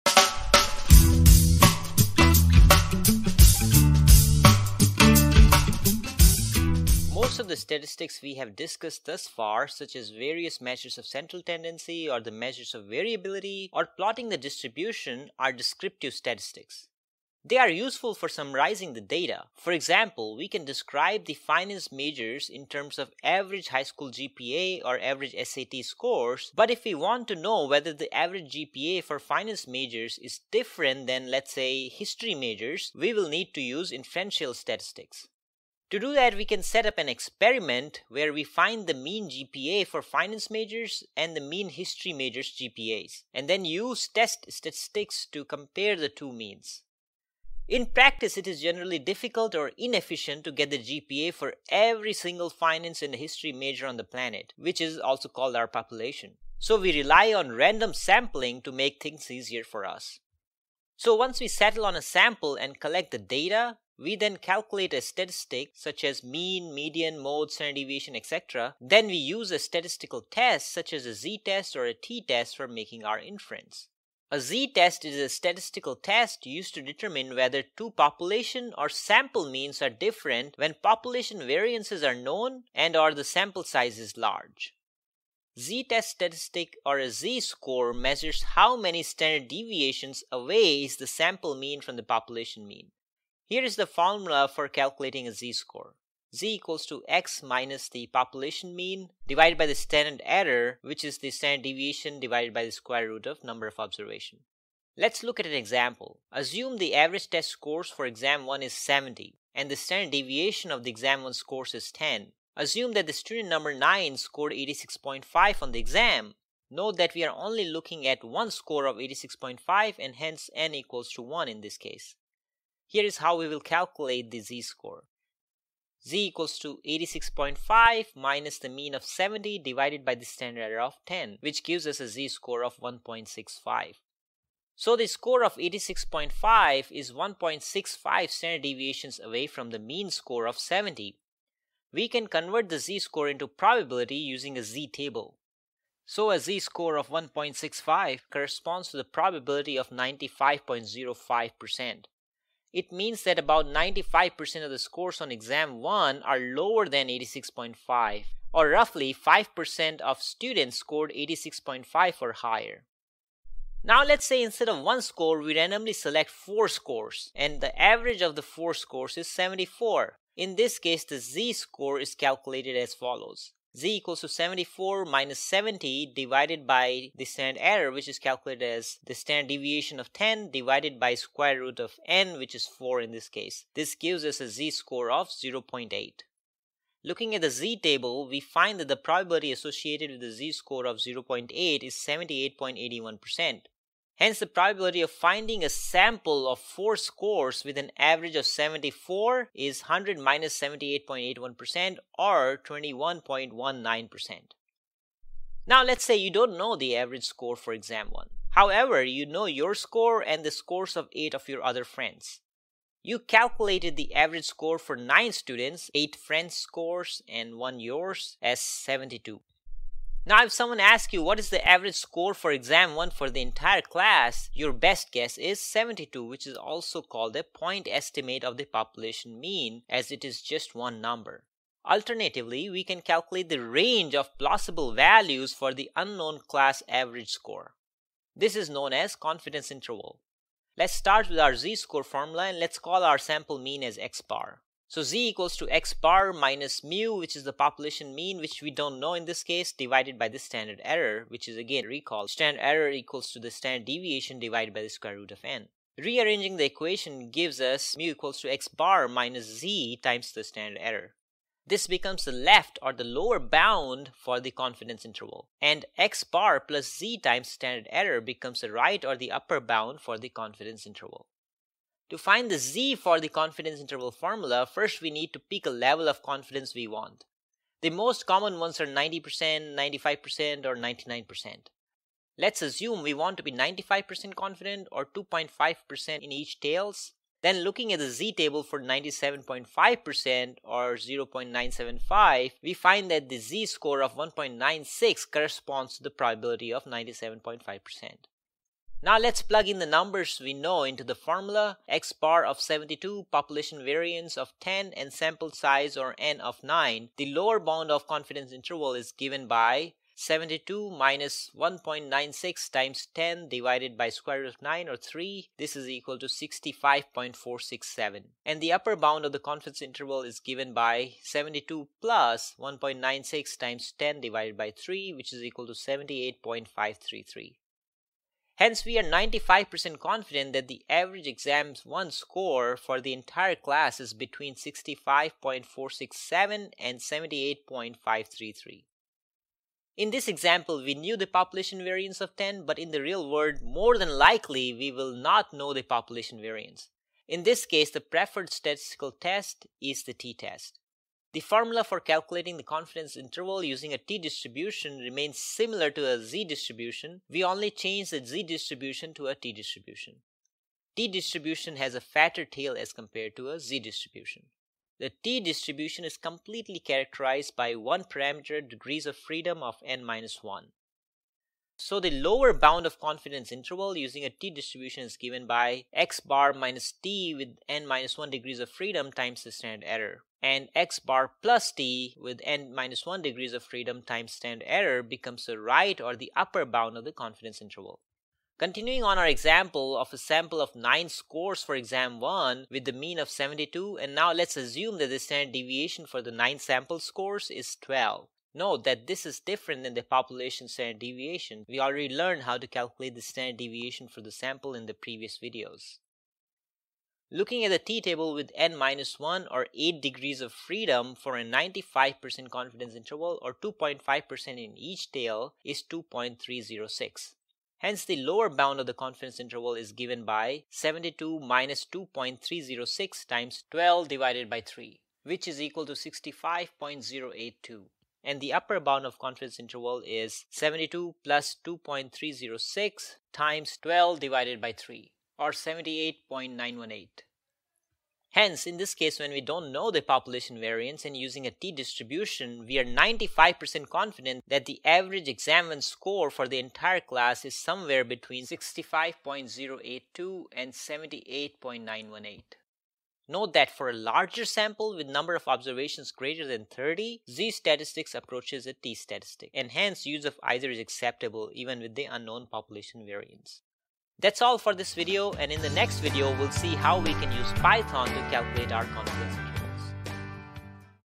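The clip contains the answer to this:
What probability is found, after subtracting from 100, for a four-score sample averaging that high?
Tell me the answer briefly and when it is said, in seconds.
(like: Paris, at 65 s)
21.19%, at 202 s.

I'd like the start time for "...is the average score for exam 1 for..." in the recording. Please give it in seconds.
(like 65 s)
221 s.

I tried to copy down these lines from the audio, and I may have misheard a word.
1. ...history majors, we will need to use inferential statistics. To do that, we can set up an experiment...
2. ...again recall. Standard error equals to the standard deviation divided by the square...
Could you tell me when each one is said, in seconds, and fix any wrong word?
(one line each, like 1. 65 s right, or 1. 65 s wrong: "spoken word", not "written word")
1. 31 s right
2. 251 s right.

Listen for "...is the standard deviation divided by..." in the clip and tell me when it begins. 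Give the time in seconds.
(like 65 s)
101 s.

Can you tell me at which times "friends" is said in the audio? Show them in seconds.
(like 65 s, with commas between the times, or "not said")
211 s, 216 s.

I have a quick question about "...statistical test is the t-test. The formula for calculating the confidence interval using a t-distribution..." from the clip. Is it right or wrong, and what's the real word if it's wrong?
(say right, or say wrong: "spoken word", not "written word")
right.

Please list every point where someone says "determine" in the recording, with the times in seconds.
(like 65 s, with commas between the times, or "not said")
76 s.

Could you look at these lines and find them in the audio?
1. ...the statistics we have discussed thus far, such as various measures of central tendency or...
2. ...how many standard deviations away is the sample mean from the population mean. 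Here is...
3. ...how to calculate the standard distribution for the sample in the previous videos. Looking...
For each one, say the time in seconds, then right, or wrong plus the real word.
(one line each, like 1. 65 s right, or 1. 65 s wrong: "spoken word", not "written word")
1. 7 s right
2. 88 s right
3. 402 s wrong: "deviation", not "distribution".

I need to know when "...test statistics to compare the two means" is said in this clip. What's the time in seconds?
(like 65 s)
44 s.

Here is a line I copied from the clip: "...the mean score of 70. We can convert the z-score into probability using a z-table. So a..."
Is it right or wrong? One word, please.
right.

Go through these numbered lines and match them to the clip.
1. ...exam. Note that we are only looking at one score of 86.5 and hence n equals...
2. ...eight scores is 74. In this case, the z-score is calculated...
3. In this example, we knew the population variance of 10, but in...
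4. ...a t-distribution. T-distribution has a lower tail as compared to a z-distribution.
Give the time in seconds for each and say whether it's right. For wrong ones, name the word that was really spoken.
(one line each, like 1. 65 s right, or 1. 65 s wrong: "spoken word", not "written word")
1. 115 s right
2. 168 s wrong: "four", not "eight"
3. 339 s right
4. 359 s wrong: "fatter", not "lower".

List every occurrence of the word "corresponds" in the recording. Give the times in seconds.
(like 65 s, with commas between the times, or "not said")
148 s, 295 s.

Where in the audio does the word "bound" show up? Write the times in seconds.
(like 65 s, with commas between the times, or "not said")
263 s, 269 s, 307 s, 318 s, 372 s, 386 s, 418 s, 428 s.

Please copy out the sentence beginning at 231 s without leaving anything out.
Alternatively, we can calculate the range of plausible values for the unknown class average score.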